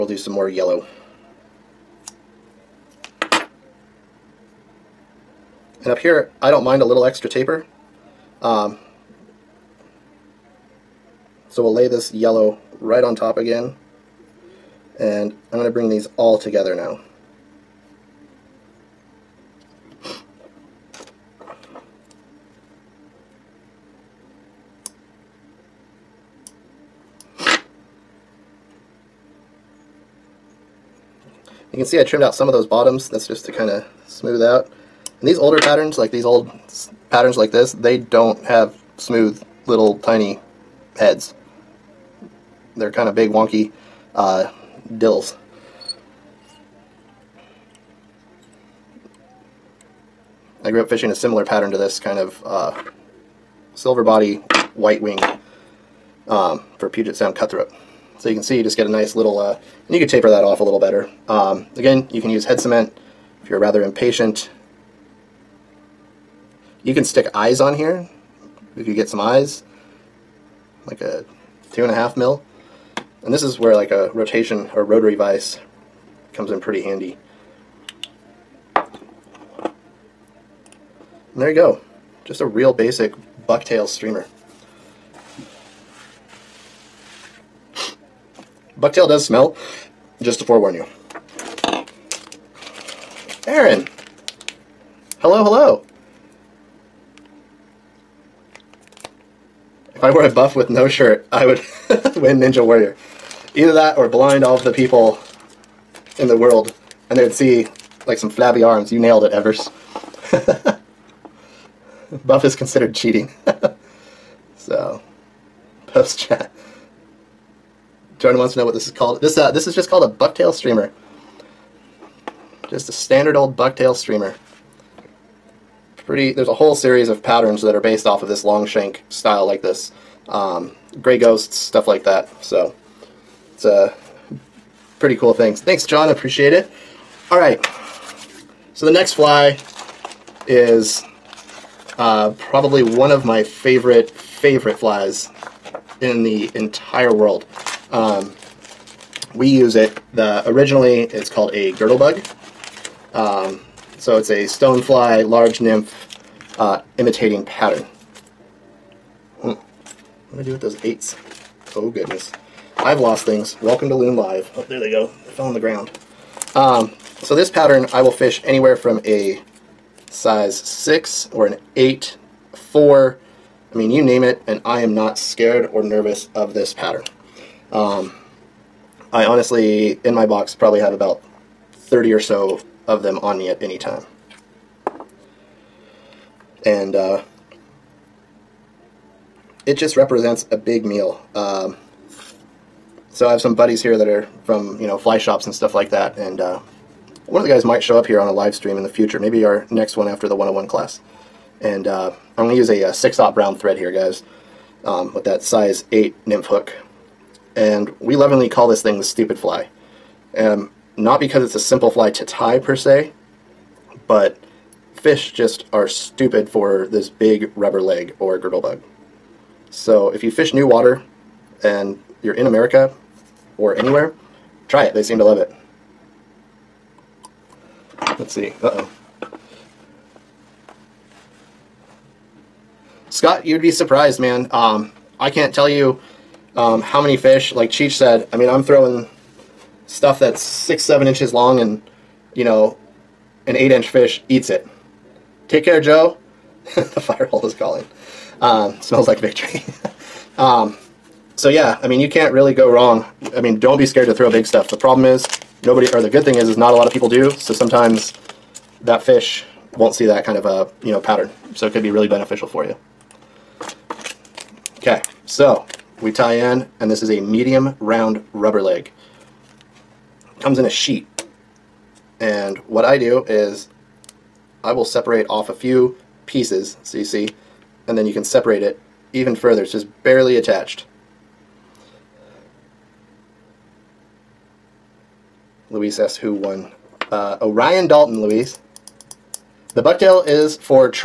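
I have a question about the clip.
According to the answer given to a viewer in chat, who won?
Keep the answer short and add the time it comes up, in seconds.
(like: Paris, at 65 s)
Orion Dalton, at 287 s.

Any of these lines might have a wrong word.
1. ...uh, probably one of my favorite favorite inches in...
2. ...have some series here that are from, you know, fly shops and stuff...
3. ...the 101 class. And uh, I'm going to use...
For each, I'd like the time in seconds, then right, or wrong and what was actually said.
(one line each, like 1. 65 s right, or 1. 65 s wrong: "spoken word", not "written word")
1. 141 s wrong: "flies", not "inches"
2. 193 s wrong: "buddies", not "series"
3. 200 s right.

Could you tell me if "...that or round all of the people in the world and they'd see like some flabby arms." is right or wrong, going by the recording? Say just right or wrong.
wrong.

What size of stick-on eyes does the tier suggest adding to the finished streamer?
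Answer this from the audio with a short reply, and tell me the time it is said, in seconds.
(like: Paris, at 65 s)
2.5 mm, at 71 s.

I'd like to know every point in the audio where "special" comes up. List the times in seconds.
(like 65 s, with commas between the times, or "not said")
not said.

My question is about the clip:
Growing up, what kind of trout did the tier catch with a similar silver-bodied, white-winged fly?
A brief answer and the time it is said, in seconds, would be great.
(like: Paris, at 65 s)
Puget Sound cutthroat, at 56 s.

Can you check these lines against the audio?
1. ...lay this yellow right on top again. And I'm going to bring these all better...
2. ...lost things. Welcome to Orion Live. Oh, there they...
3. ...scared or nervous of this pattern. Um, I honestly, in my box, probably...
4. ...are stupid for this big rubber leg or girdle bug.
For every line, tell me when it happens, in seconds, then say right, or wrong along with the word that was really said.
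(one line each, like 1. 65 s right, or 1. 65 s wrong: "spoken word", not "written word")
1. 11 s wrong: "together", not "better"
2. 162 s wrong: "Loon", not "Orion"
3. 175 s right
4. 215 s right.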